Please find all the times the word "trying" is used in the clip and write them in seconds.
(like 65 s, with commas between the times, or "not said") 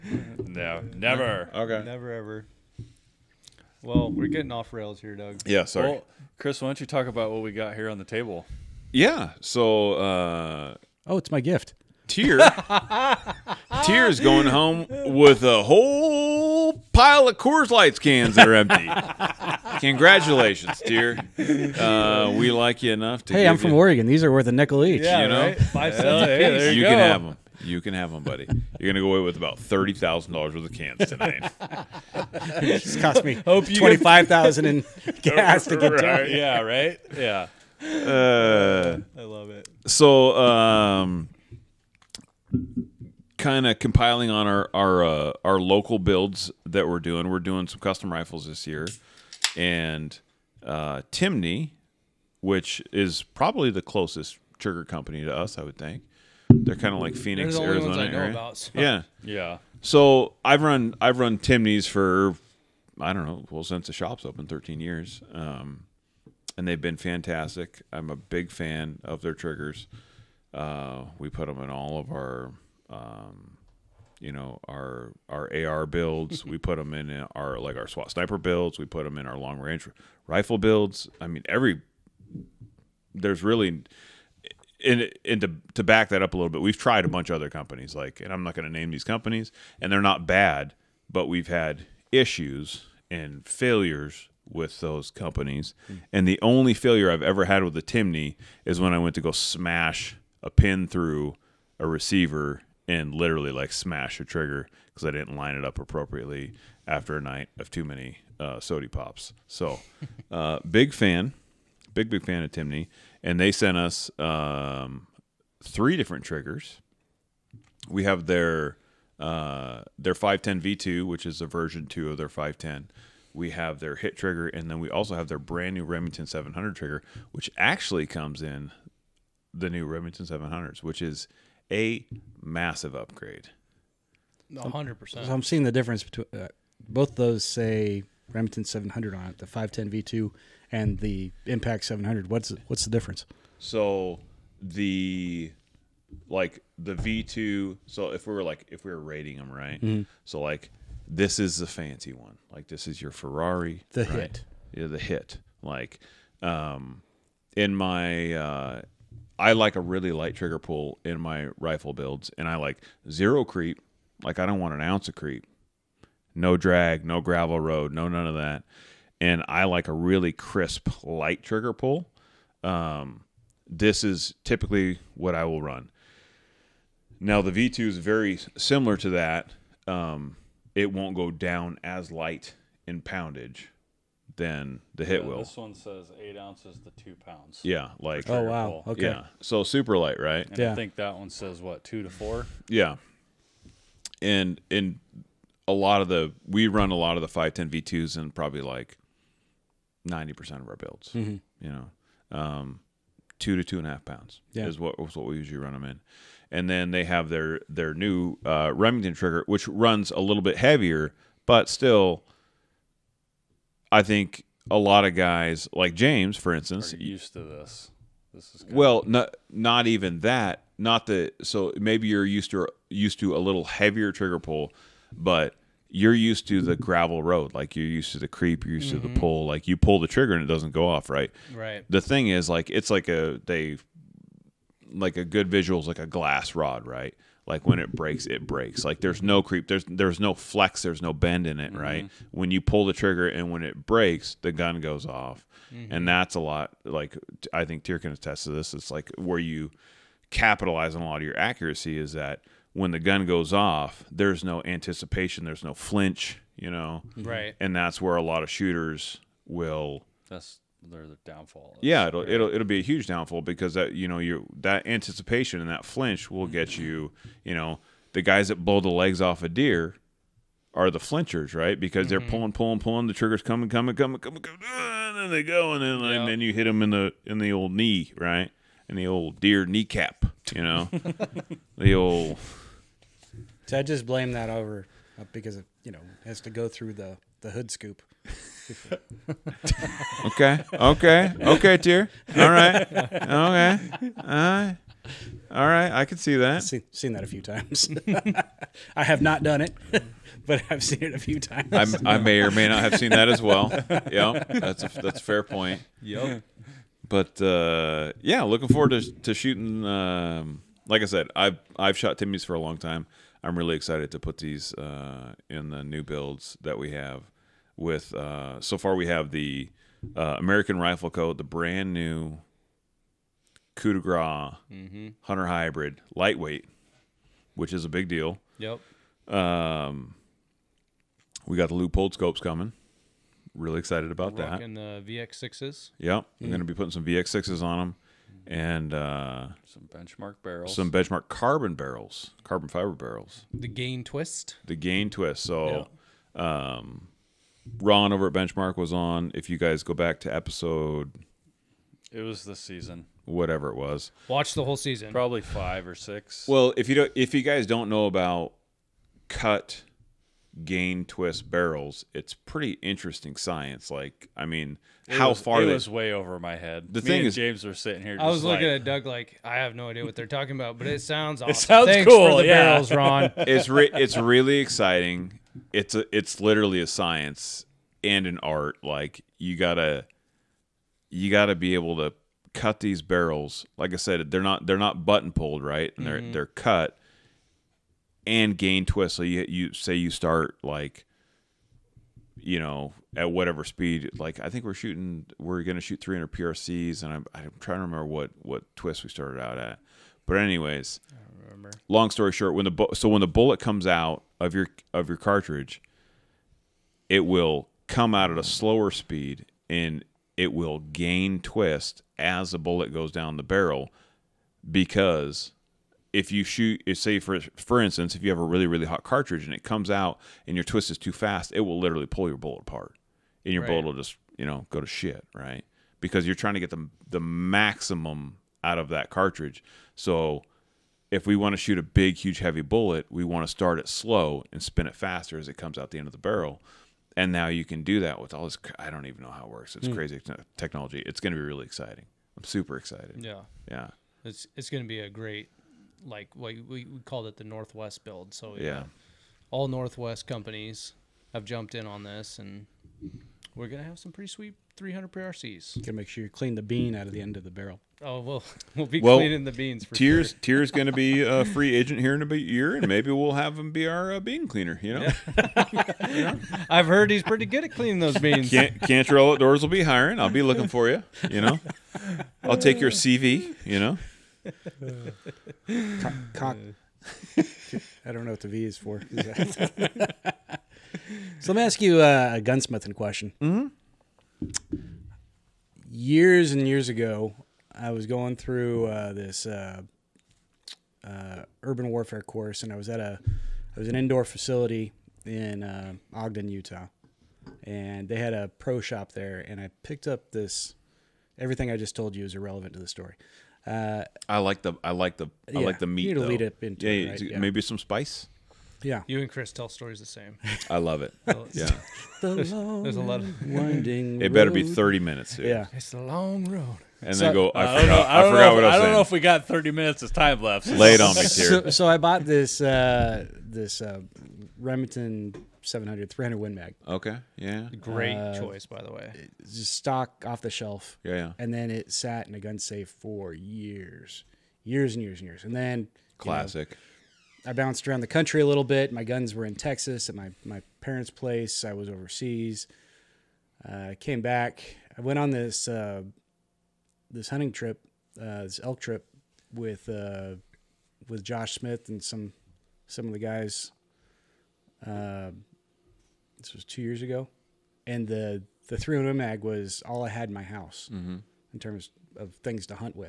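397 s, 426 s.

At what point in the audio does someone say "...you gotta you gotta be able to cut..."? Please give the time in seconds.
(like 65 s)
379 s.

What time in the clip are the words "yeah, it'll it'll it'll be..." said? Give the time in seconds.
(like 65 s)
261 s.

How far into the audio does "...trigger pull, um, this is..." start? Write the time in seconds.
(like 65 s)
171 s.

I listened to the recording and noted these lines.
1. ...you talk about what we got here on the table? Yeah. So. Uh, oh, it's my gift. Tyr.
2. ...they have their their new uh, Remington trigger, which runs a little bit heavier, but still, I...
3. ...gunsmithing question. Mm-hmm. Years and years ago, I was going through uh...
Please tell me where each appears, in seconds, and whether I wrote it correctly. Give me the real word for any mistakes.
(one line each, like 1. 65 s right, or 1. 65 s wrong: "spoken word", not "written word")
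1. 6 s right
2. 206 s right
3. 482 s right.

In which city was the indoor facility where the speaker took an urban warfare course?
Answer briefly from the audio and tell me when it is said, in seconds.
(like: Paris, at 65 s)
Ogden, Utah, at 496 s.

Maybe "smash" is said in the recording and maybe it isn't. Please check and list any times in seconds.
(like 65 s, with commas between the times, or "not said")
99 s, 103 s.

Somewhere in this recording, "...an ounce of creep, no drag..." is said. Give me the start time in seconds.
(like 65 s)
164 s.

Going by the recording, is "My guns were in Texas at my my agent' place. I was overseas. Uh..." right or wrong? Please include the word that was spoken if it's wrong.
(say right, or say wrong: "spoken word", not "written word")
wrong: "parents", not "agent".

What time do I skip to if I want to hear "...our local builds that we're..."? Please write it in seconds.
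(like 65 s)
45 s.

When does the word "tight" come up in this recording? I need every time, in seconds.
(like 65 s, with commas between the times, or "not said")
not said.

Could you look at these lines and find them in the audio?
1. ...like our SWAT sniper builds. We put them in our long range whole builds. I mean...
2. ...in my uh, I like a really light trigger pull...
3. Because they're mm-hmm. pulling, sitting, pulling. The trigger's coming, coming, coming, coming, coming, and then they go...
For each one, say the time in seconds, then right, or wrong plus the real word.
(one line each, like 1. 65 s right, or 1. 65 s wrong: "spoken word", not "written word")
1. 77 s wrong: "rifle", not "whole"
2. 157 s right
3. 271 s wrong: "pulling", not "sitting".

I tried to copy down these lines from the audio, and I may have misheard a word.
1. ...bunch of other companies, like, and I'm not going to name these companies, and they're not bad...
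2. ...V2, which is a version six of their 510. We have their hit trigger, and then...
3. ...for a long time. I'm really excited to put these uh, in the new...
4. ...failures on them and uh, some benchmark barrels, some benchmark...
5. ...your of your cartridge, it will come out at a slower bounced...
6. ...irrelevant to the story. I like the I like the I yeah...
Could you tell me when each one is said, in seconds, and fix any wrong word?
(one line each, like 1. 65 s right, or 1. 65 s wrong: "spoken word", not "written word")
1. 87 s right
2. 120 s wrong: "two", not "six"
3. 312 s right
4. 337 s wrong: "sixes", not "failures"
5. 404 s wrong: "speed", not "bounced"
6. 502 s right.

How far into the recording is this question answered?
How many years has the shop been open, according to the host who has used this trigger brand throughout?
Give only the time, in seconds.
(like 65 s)
64 s.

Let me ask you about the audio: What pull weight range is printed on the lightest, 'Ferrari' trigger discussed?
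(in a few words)
8 ounces to 2 pounds.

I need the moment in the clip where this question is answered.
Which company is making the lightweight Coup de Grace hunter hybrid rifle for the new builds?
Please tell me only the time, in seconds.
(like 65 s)
320 s.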